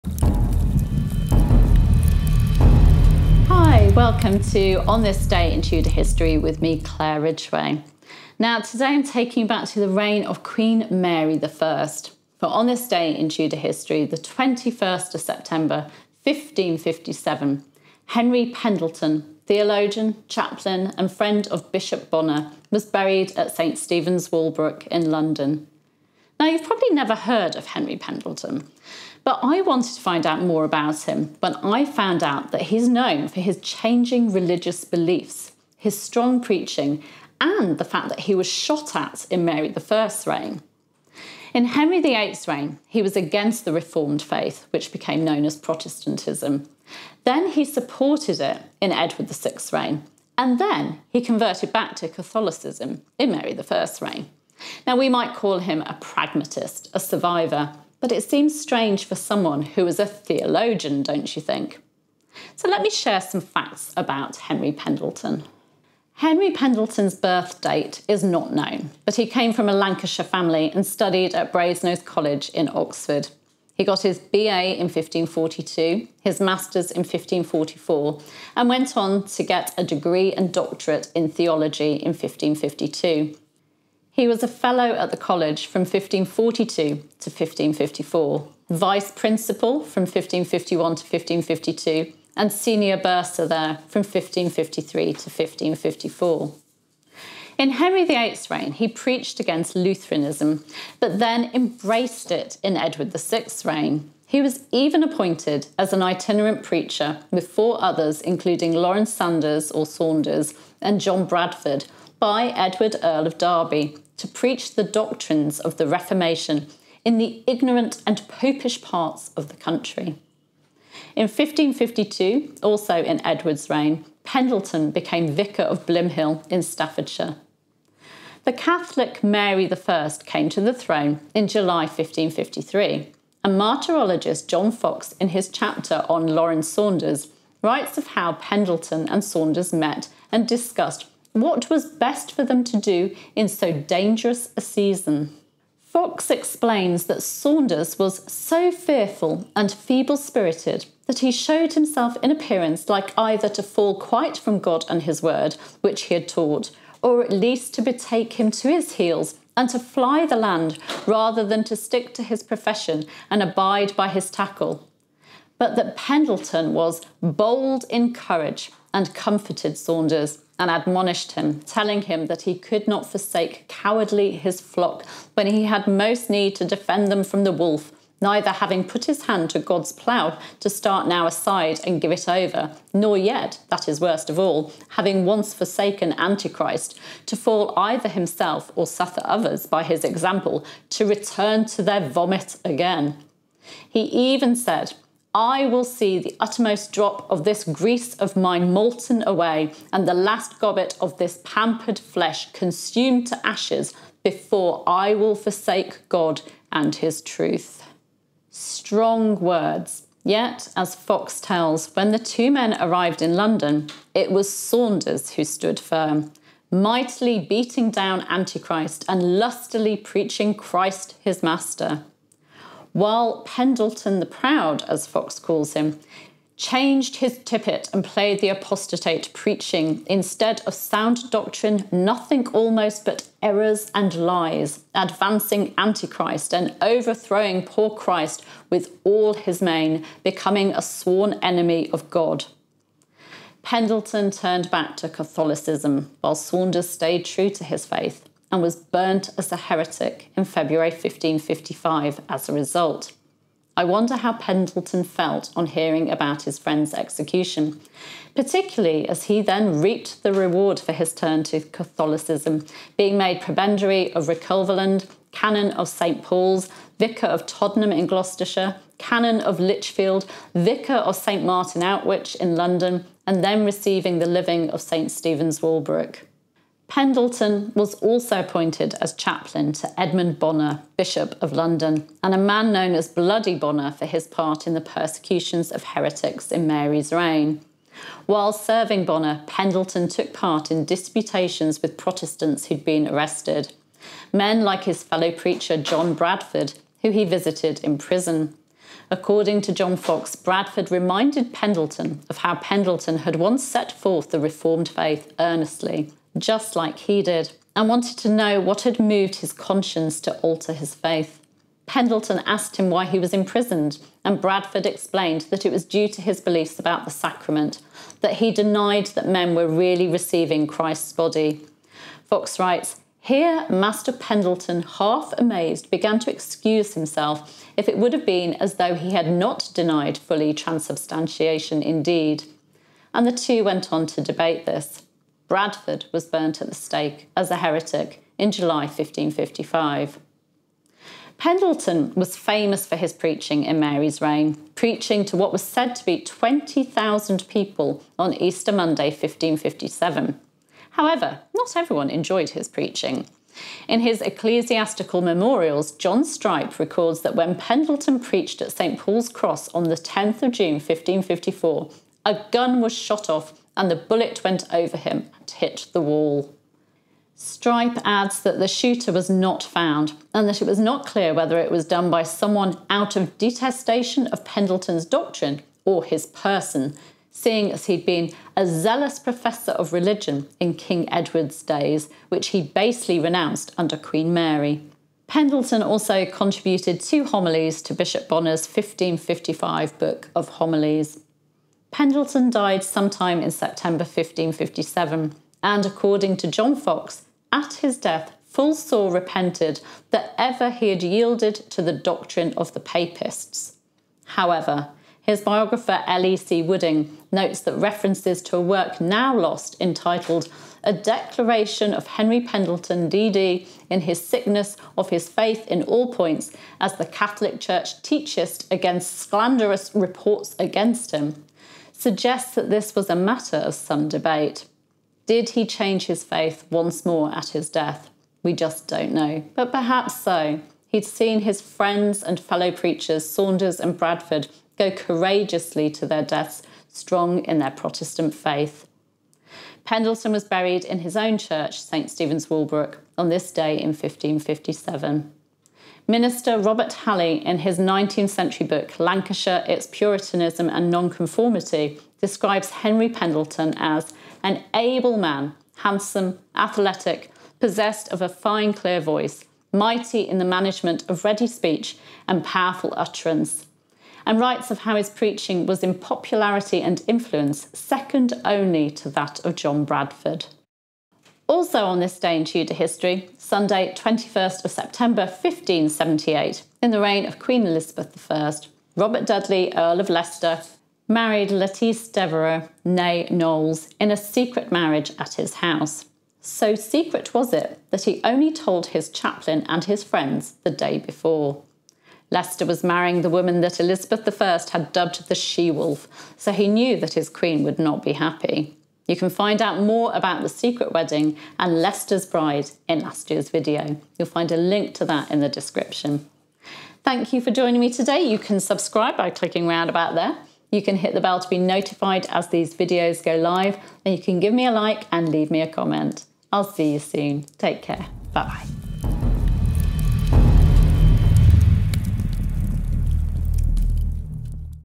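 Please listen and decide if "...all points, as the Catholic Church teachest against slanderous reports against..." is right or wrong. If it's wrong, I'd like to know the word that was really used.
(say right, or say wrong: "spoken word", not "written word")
right.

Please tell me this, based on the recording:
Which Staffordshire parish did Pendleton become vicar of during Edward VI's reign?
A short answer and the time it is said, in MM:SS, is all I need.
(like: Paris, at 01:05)
Blymhill, at 02:05.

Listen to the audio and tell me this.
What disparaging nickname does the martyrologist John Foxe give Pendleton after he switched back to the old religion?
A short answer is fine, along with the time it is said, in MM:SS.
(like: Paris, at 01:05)
Pendleton the Proud, at 03:43.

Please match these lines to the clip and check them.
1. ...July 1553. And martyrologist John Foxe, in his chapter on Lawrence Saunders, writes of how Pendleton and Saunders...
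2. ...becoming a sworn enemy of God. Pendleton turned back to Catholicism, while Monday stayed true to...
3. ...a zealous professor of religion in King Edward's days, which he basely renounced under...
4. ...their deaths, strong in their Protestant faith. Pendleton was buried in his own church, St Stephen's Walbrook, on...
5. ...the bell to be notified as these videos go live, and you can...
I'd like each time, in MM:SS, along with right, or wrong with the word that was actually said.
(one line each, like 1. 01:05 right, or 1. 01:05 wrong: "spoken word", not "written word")
1. 02:11 right
2. 04:00 wrong: "Saunders", not "Monday"
3. 06:18 right
4. 07:16 right
5. 08:31 right.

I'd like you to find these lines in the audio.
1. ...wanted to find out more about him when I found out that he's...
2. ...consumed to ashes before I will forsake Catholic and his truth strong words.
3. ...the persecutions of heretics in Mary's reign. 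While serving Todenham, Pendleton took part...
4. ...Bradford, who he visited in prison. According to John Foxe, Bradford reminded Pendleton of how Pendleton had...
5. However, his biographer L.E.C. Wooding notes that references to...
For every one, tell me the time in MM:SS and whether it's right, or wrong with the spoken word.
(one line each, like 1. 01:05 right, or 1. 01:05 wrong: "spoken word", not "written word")
1. 00:29 right
2. 03:22 wrong: "God", not "Catholic"
3. 04:44 wrong: "Bonner", not "Todenham"
4. 04:56 right
5. 06:44 right.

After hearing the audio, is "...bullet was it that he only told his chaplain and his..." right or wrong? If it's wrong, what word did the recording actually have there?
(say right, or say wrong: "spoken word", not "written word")
wrong: "secret", not "bullet".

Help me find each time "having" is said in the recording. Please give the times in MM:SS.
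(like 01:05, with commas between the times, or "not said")
02:58, 03:04.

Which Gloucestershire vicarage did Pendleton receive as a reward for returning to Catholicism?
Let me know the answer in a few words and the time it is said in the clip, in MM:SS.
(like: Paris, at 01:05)
Todenham, at 04:27.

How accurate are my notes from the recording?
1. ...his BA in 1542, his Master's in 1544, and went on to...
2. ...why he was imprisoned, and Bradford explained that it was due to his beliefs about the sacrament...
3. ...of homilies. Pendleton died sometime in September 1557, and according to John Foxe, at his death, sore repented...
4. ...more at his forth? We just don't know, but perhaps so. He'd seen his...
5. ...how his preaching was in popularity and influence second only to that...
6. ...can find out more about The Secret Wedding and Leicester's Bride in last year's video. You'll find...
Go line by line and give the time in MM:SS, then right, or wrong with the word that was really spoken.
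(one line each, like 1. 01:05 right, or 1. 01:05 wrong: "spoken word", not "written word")
1. 01:14 right
2. 05:12 right
3. 06:30 right
4. 07:07 wrong: "death", not "forth"
5. 07:44 right
6. 08:19 right.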